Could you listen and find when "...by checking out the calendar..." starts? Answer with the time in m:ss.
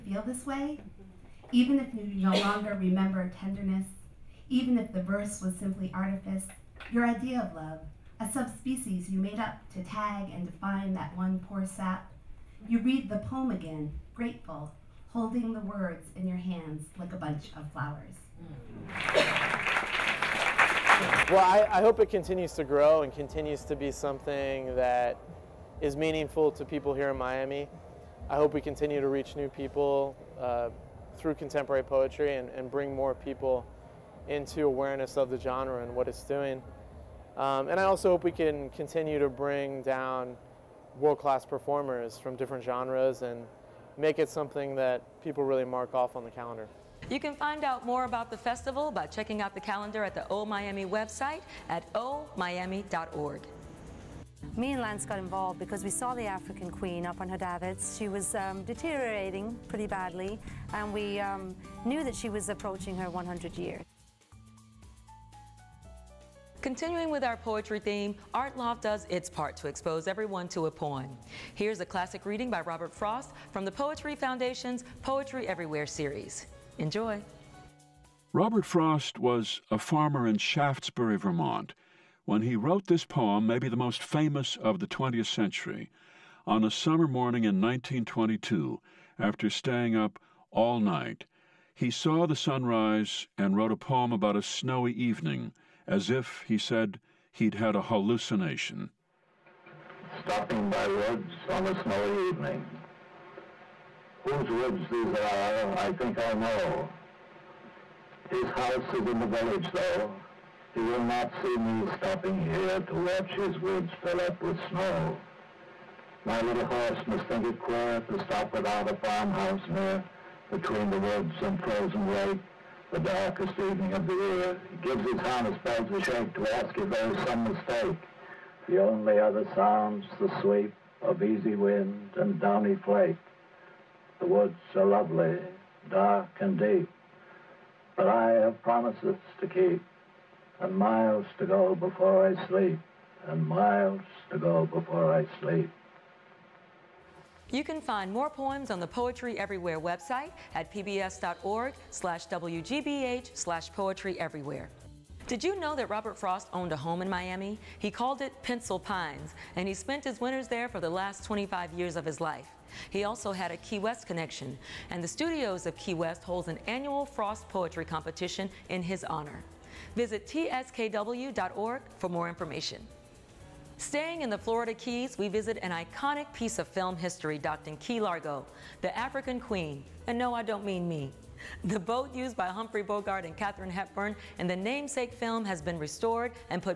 0:48.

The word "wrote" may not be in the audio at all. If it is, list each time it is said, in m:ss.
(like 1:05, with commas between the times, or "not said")
1:22, 1:33.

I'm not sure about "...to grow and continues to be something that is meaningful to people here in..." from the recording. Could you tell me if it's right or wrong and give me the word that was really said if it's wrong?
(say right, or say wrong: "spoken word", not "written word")
right.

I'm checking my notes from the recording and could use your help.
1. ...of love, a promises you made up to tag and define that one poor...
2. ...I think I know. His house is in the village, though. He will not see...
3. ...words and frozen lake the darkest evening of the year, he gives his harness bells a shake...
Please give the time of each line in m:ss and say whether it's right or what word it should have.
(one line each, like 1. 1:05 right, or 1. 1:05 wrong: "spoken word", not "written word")
1. 0:07 wrong: "subspecies", not "promises"
2. 1:45 right
3. 2:00 wrong: "woods", not "words".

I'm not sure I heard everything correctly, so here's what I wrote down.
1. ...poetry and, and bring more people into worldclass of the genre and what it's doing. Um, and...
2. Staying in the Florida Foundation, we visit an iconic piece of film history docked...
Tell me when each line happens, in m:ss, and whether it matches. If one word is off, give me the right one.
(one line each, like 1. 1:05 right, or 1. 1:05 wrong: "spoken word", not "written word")
1. 0:31 wrong: "awareness", not "worldclass"
2. 2:53 wrong: "Keys", not "Foundation".